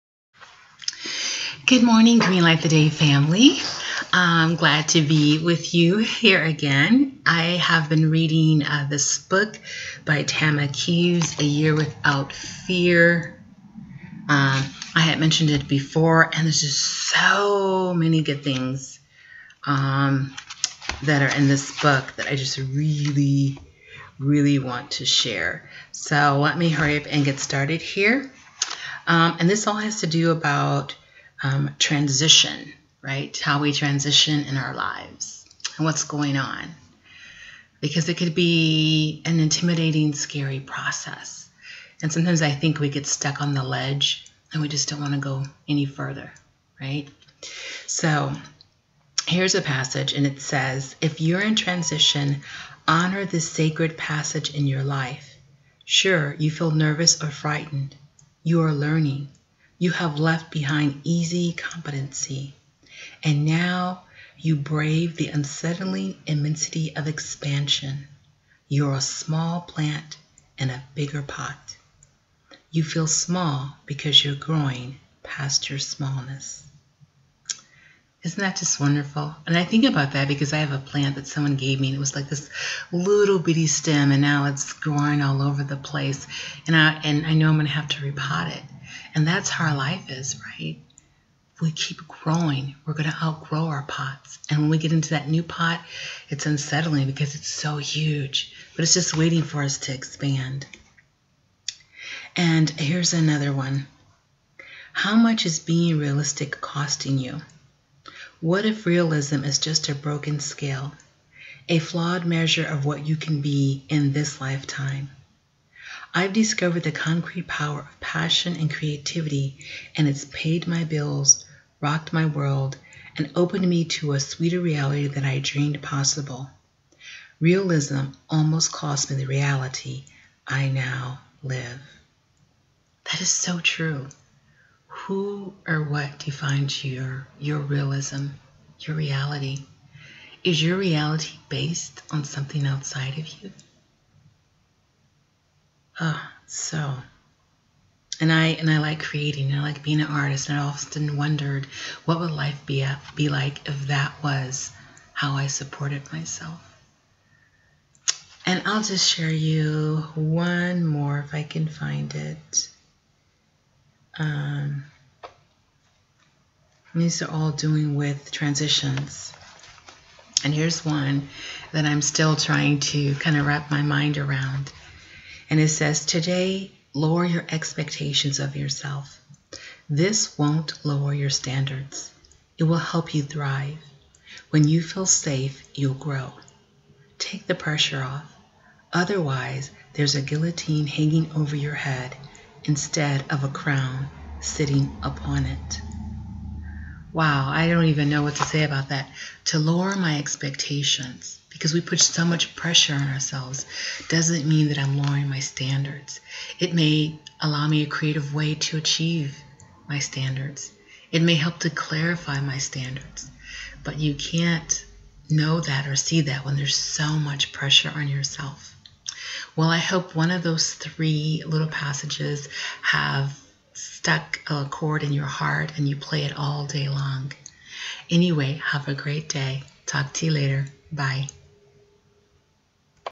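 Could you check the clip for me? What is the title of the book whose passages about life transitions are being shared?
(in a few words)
A Year Without Fear.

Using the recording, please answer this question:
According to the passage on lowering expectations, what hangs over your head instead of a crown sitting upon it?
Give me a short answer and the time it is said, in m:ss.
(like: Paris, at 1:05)
A guillotine, at 3:10.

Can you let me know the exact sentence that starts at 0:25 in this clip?
So let me hurry up and get started here.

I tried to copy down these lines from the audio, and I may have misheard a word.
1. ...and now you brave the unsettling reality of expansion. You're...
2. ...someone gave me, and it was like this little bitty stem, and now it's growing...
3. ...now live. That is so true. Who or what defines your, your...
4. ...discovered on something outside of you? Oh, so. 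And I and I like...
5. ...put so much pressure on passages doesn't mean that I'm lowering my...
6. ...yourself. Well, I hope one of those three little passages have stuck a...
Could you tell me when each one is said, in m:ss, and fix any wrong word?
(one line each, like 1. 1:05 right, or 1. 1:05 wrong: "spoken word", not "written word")
1. 1:03 wrong: "immensity", not "reality"
2. 1:21 right
3. 2:10 right
4. 2:21 wrong: "based", not "discovered"
5. 3:21 wrong: "ourselves", not "passages"
6. 3:38 right.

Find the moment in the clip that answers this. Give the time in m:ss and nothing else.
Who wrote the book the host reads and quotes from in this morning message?
0:10.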